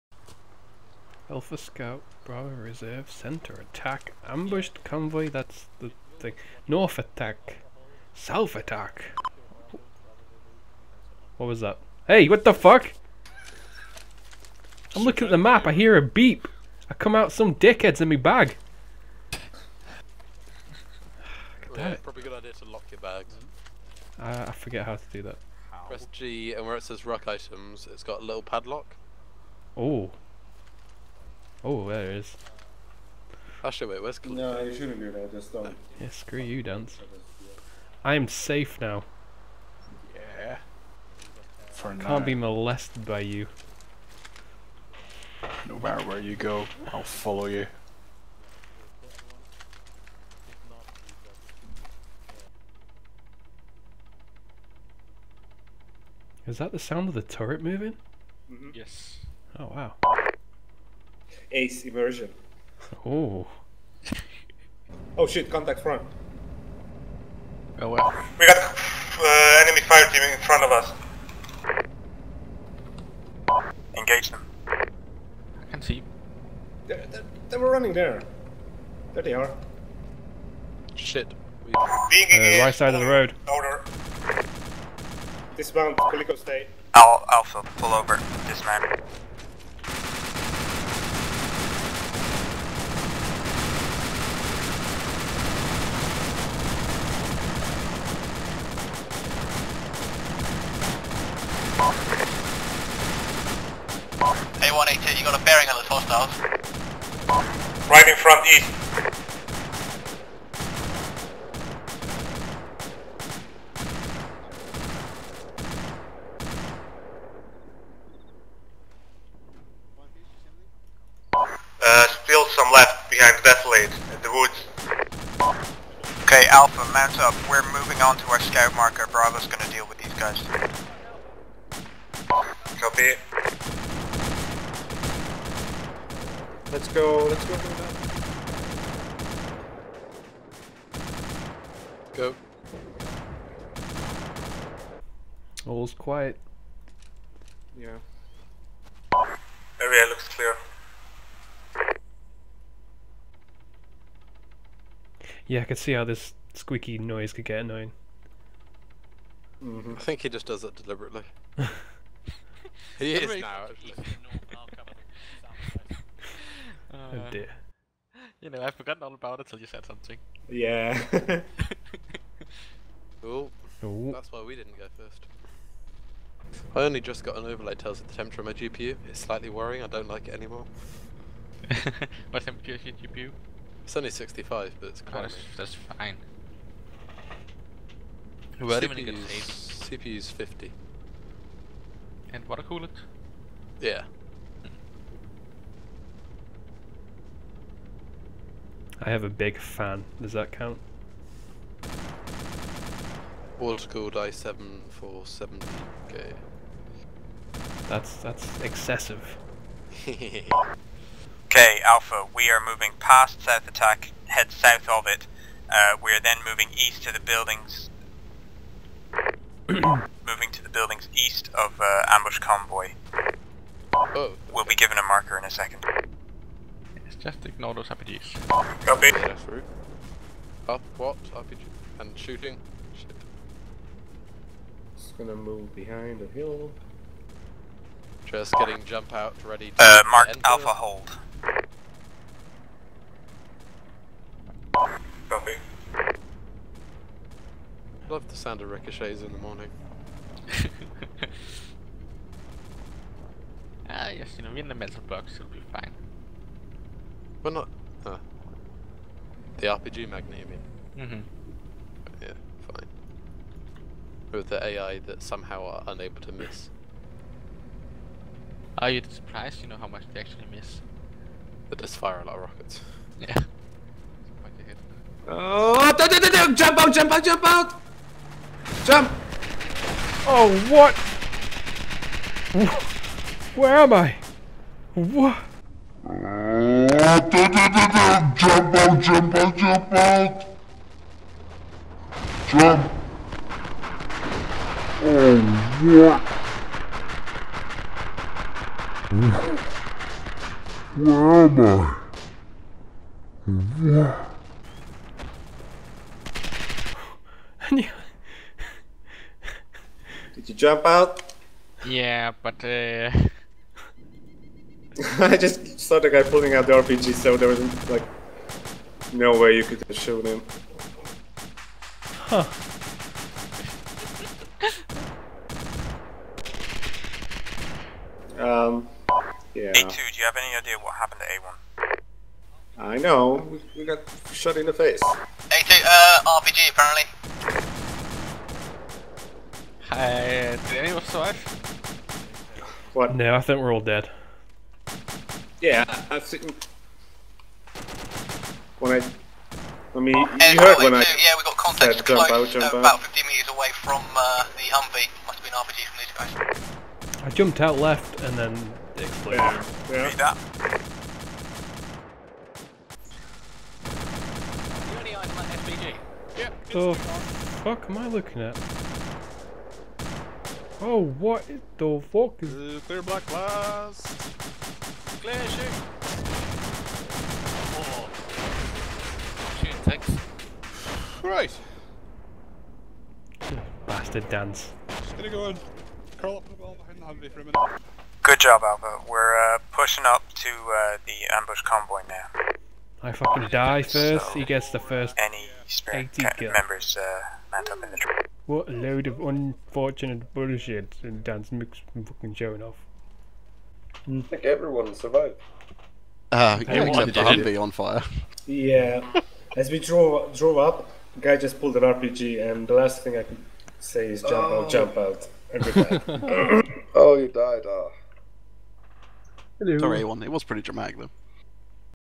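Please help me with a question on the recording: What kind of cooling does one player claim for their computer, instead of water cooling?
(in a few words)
A big fan.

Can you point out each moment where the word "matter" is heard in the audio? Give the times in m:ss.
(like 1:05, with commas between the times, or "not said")
0:45.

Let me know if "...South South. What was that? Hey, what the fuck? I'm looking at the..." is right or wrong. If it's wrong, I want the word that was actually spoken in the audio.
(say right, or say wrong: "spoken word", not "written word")
wrong: "Attack", not "South".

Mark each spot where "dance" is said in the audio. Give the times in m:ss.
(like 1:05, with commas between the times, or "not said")
0:36, 6:24.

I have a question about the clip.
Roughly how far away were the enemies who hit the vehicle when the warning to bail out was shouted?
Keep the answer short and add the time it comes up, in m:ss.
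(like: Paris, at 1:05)
50 meters, at 5:53.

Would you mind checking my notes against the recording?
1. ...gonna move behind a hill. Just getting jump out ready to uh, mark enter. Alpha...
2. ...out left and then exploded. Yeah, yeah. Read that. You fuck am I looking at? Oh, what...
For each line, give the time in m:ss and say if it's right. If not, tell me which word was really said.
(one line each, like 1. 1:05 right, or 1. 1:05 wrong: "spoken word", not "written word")
1. 3:55 right
2. 5:57 right.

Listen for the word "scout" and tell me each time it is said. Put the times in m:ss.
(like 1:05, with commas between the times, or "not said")
0:01, 2:08.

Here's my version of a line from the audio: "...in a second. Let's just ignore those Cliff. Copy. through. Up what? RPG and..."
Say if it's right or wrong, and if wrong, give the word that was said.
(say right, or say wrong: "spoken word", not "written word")
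wrong: "RPGs", not "Cliff".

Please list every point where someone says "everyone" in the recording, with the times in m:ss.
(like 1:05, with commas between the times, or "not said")
6:44, 6:59.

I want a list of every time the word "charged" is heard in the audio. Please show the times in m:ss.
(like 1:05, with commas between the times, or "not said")
not said.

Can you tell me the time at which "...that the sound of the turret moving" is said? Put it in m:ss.
0:56.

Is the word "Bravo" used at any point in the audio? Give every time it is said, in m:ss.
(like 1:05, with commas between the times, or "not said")
0:02, 2:09.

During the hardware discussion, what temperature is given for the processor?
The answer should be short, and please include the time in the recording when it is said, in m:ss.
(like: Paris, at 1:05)
50, at 3:09.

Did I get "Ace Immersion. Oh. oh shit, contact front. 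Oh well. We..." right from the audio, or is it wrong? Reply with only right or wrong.
right.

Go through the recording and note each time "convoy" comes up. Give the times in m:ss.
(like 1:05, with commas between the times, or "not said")
0:04, 3:42, 6:31.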